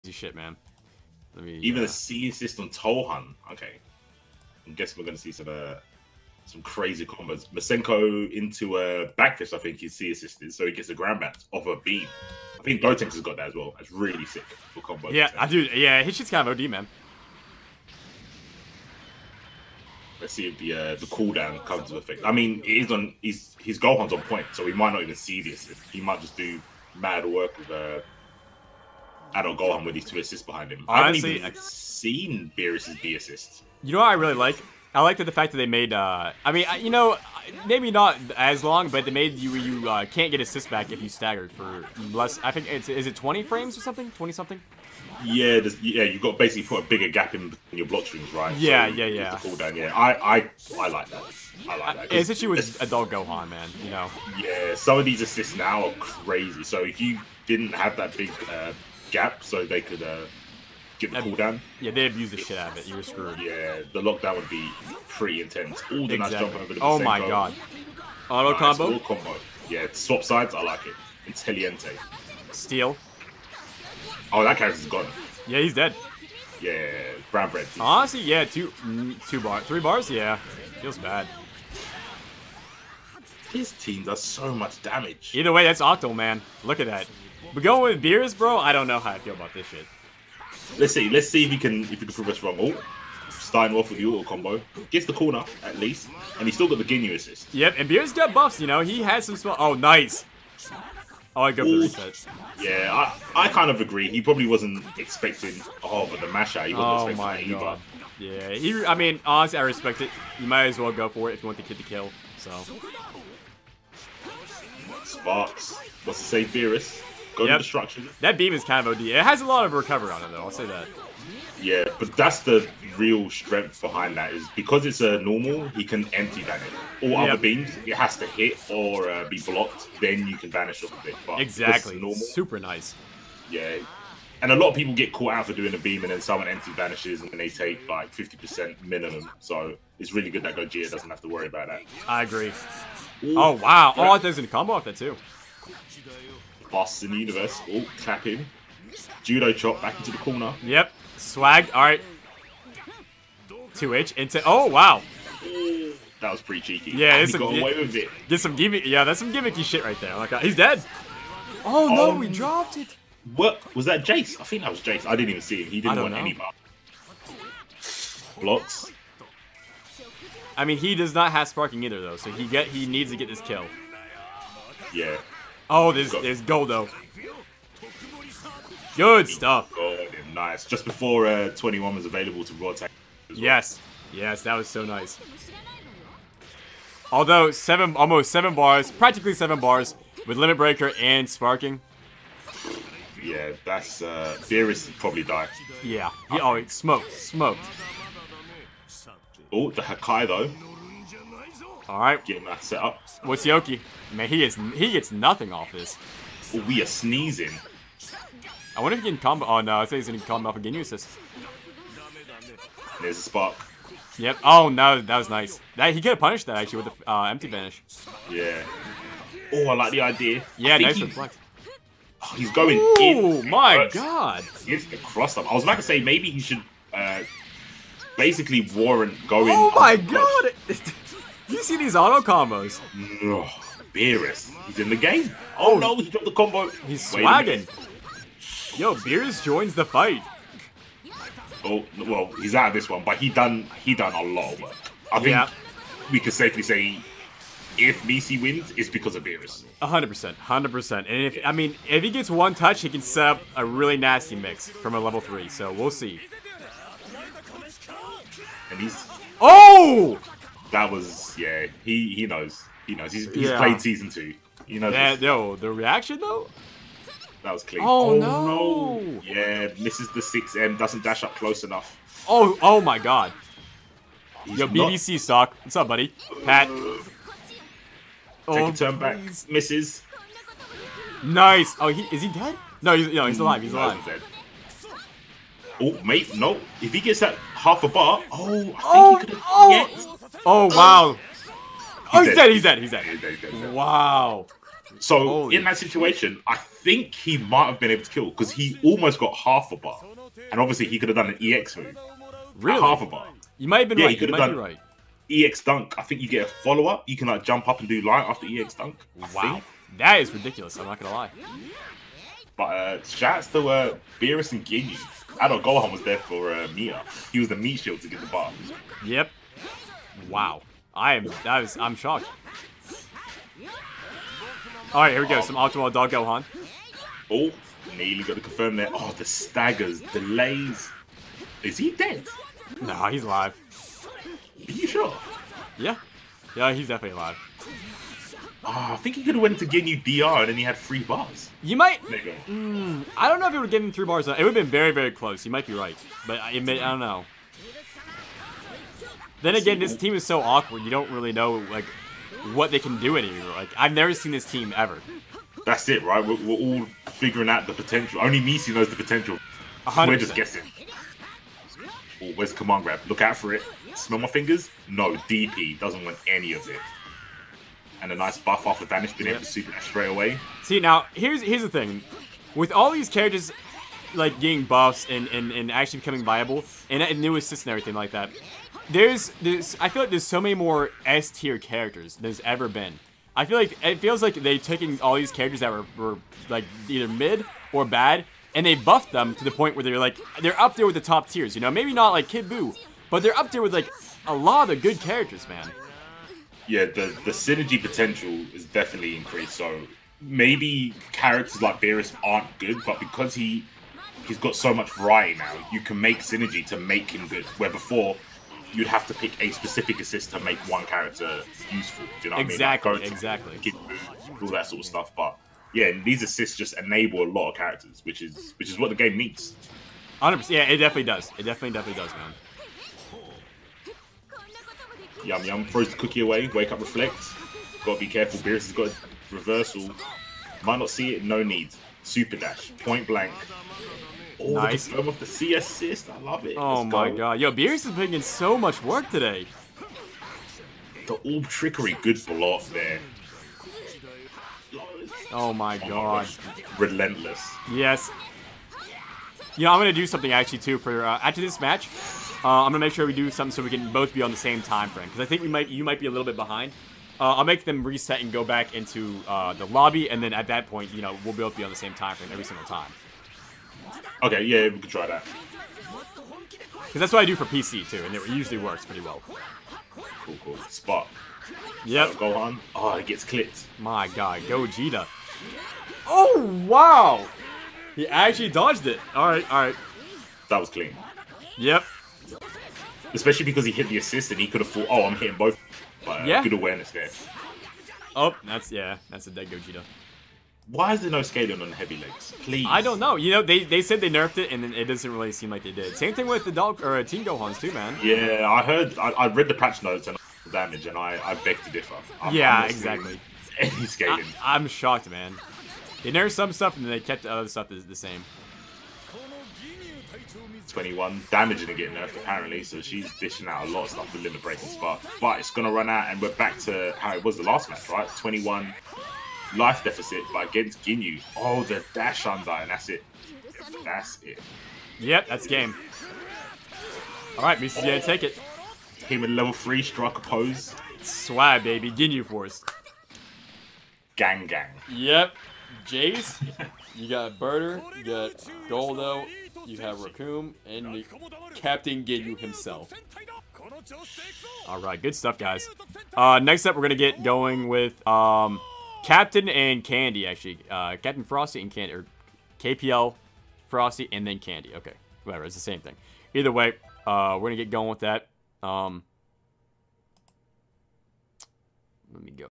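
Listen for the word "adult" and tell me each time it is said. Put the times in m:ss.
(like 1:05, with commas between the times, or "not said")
0:29, 0:52.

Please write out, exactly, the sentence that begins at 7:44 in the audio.
Okay, yeah, we could try that.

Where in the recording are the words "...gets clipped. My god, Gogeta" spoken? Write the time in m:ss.
7:53.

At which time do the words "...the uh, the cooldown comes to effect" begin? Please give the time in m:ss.
0:20.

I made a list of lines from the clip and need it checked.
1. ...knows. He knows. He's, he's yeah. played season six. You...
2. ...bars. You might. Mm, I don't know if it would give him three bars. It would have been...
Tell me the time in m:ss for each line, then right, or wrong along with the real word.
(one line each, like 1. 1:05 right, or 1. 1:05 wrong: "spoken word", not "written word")
1. 4:22 wrong: "two", not "six"
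2. 5:41 right.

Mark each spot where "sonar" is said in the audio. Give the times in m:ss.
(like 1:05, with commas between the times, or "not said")
not said.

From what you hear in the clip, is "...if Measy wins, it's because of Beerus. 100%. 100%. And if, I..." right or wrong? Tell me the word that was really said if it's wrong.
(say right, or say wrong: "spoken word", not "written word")
right.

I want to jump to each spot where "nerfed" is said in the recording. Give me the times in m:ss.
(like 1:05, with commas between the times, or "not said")
8:14, 8:26, 8:31.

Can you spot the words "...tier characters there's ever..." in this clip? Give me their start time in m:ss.
6:21.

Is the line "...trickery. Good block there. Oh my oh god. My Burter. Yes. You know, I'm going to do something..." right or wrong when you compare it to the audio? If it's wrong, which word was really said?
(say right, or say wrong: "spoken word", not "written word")
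wrong: "Relentless", not "Burter".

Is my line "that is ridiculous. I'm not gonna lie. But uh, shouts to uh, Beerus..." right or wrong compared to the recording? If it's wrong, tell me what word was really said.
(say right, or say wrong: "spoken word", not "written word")
right.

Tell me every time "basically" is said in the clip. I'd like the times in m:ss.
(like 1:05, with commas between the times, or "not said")
0:46, 3:48.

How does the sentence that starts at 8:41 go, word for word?
Oh, the dash under, and that's it.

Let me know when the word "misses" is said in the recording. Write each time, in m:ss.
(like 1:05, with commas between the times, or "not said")
4:29, 4:39.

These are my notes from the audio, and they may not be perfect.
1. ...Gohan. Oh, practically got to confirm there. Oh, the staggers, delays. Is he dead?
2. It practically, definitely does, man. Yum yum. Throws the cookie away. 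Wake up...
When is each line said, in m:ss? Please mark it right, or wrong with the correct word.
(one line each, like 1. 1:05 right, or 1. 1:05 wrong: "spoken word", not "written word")
1. 5:26 wrong: "nearly", not "practically"
2. 7:01 wrong: "definitely", not "practically".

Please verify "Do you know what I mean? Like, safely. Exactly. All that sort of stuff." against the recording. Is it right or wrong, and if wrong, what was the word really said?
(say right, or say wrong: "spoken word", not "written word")
wrong: "exactly", not "safely".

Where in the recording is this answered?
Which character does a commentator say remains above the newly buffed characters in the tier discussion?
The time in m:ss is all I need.
6:32.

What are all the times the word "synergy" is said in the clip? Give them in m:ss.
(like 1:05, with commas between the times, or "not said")
6:37, 6:46.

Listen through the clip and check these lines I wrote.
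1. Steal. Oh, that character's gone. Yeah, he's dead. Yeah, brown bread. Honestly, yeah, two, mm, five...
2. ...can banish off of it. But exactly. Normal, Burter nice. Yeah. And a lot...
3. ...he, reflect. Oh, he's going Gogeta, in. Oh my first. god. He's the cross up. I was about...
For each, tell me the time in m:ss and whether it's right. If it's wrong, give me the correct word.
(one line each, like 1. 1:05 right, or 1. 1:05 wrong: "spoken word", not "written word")
1. 1:12 wrong: "two", not "five"
2. 2:10 wrong: "Super", not "Burter"
3. 3:40 wrong: "Ooh", not "Gogeta".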